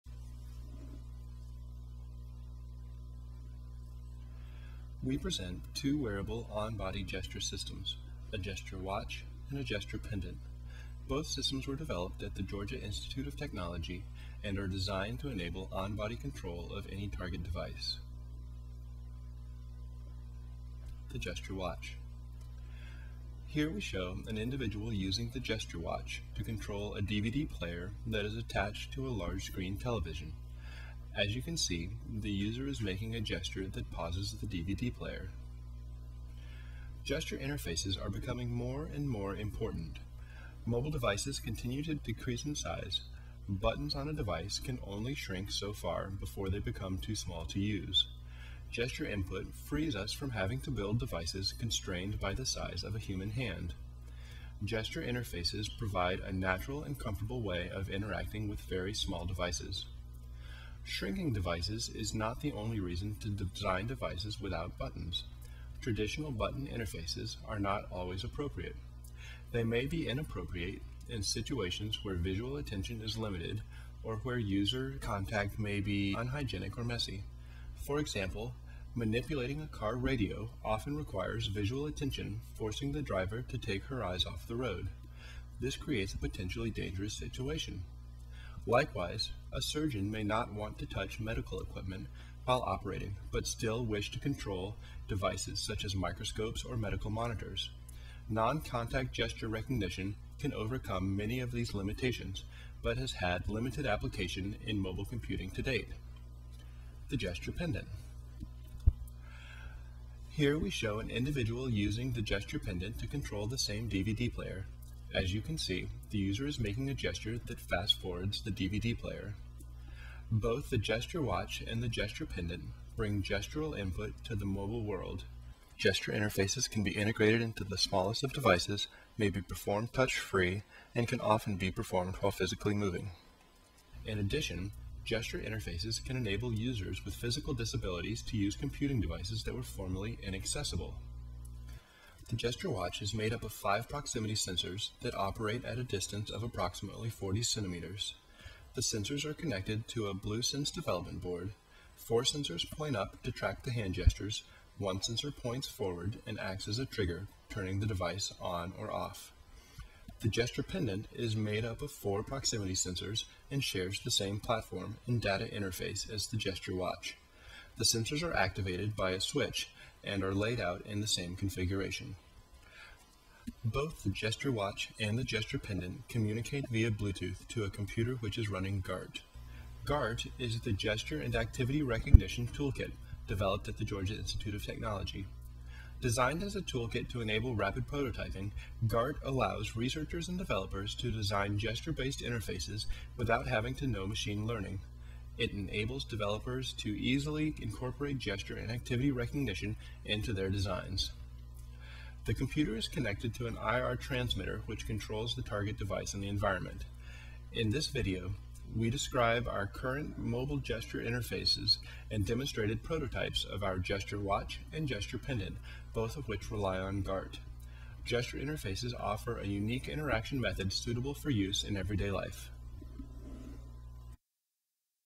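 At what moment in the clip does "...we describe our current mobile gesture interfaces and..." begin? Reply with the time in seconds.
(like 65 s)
208 s.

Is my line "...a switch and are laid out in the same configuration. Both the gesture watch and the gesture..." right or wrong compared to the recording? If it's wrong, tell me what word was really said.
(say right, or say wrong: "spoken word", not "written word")
right.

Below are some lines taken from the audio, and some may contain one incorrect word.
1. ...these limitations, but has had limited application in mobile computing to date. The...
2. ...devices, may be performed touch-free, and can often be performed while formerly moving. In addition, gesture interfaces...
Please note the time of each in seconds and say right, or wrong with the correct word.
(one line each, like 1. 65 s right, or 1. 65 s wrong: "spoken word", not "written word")
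1. 101 s right
2. 128 s wrong: "physically", not "formerly".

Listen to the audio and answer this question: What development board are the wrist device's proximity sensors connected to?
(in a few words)
BlueSense.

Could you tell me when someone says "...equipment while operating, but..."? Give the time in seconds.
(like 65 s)
91 s.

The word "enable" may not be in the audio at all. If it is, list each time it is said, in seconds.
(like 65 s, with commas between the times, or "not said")
15 s, 136 s, 187 s, 195 s.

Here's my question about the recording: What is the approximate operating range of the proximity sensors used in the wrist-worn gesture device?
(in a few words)
40 centimeters.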